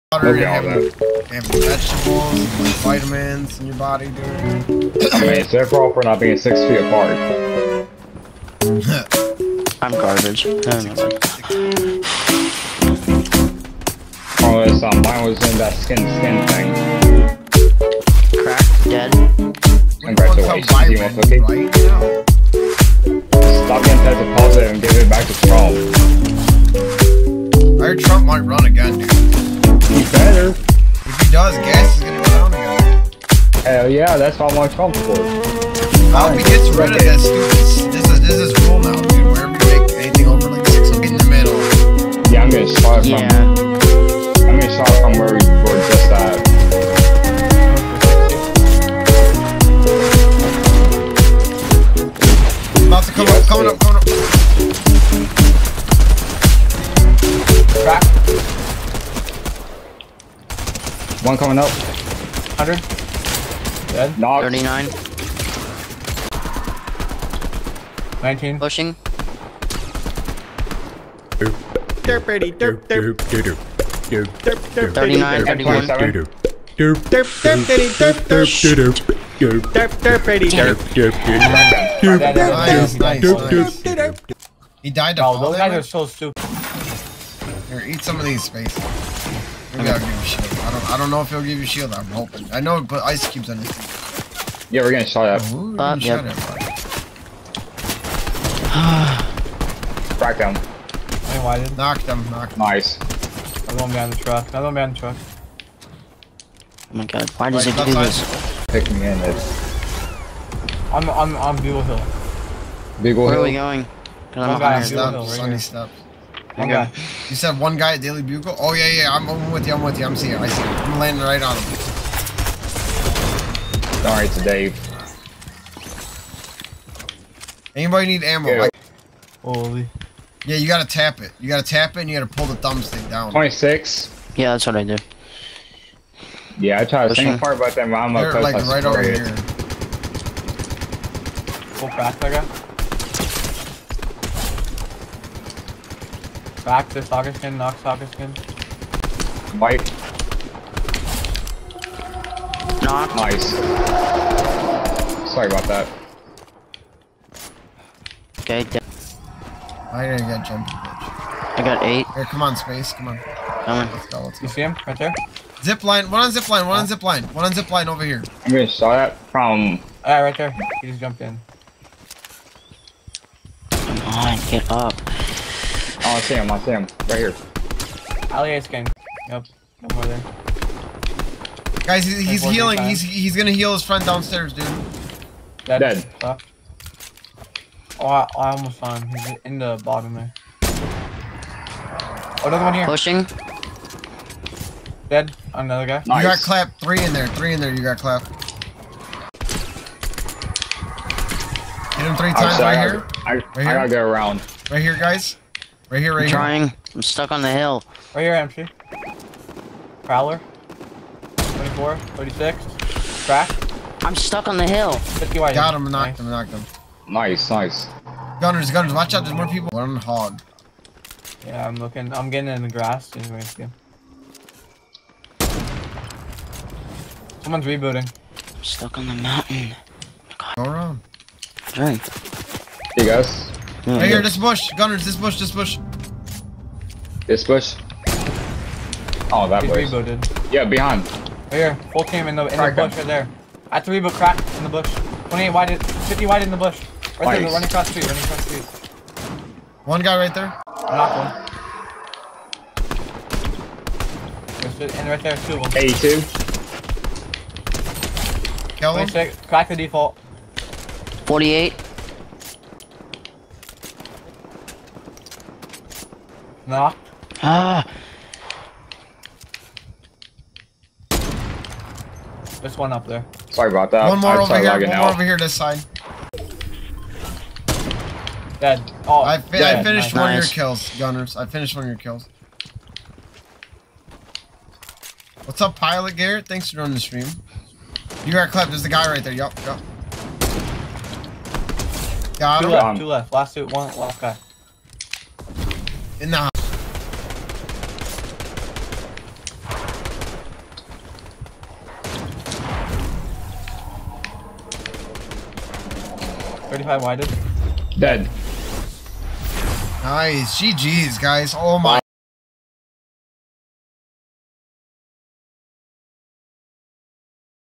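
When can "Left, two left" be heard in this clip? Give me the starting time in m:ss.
4:52.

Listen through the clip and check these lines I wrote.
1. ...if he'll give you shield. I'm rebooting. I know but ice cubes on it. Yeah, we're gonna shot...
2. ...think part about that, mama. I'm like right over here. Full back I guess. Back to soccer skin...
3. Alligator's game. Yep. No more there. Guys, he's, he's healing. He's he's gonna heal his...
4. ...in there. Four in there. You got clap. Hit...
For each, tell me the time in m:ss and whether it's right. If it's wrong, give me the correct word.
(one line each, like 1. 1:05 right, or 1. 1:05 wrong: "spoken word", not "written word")
1. 1:31 wrong: "hoping", not "rebooting"
2. 2:17 right
3. 2:58 right
4. 3:17 wrong: "Three", not "Four".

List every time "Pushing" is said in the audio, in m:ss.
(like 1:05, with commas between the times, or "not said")
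1:08, 3:12.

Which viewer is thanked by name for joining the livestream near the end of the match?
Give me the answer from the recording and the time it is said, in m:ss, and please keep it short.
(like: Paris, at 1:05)
Pilot Garrett, at 4:45.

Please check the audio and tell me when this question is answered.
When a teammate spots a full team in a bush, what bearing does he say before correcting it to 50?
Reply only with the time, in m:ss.
4:05.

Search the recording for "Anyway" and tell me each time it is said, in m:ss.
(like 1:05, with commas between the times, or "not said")
1:41, 3:43.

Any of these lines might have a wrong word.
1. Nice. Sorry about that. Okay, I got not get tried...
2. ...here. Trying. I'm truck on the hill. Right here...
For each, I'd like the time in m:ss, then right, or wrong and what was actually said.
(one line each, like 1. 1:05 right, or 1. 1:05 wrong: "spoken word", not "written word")
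1. 2:33 wrong: "jumped", not "tried"
2. 3:26 wrong: "stuck", not "truck".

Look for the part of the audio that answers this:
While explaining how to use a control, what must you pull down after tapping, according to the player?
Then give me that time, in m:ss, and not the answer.
2:12.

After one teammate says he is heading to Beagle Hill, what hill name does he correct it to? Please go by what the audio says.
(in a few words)
Sunny Hill.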